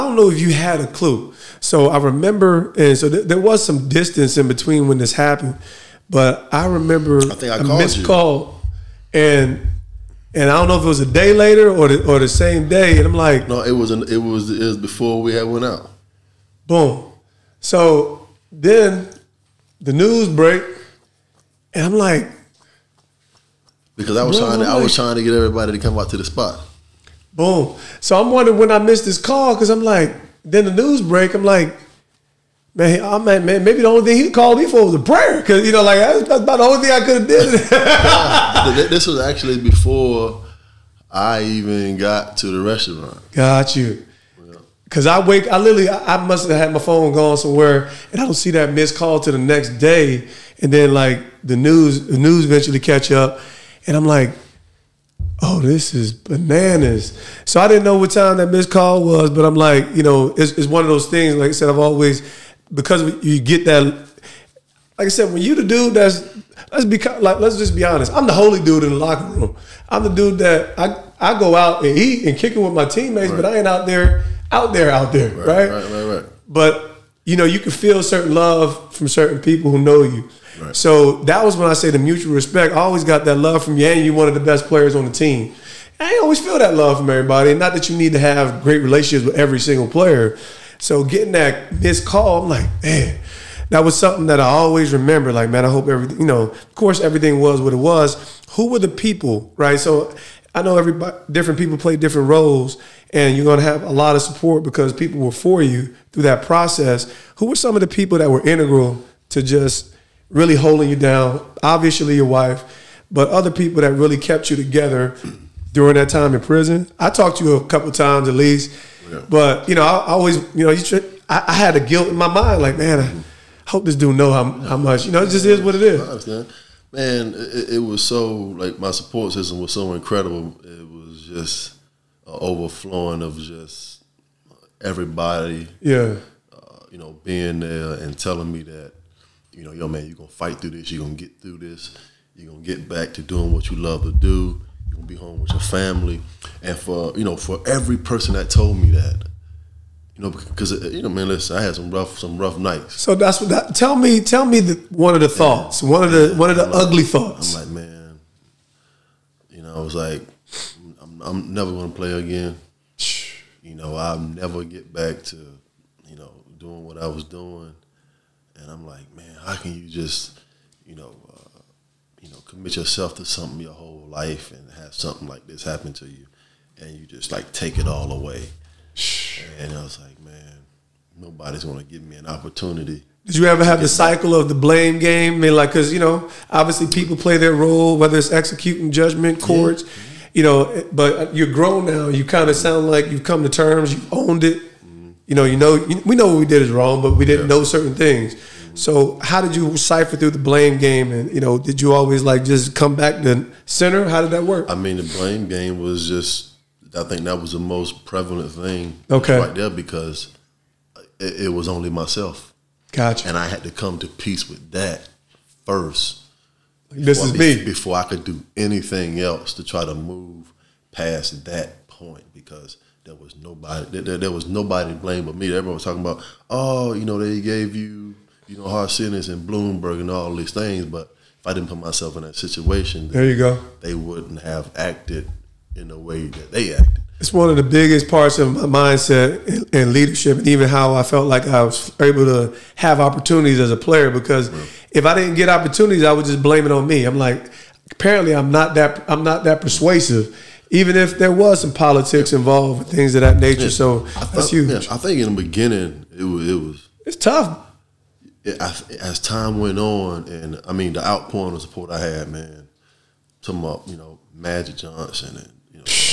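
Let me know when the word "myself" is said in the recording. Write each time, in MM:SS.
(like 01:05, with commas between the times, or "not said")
03:31, 03:51.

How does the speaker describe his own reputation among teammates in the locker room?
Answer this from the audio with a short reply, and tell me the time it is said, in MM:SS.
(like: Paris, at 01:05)
The holy dude, at 01:08.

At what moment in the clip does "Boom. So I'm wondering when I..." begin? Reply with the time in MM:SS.
00:27.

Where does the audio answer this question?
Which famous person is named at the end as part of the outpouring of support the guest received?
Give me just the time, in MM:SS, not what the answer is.
04:24.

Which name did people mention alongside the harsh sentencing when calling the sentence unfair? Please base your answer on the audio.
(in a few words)
Bloomberg.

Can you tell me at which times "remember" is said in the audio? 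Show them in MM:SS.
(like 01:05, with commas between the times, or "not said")
00:01, 00:06, 01:34.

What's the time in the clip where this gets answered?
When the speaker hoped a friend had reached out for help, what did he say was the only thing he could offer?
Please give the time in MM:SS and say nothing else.
00:34.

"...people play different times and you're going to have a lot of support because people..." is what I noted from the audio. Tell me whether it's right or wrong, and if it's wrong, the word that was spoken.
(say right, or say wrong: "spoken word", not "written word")
wrong: "roles", not "times".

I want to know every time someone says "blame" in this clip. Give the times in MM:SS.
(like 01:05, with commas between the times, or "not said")
03:04, 03:20, 03:25, 03:44, 04:06.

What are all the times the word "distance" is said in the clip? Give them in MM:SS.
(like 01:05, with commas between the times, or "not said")
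00:03.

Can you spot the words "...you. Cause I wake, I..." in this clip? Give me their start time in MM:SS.
00:43.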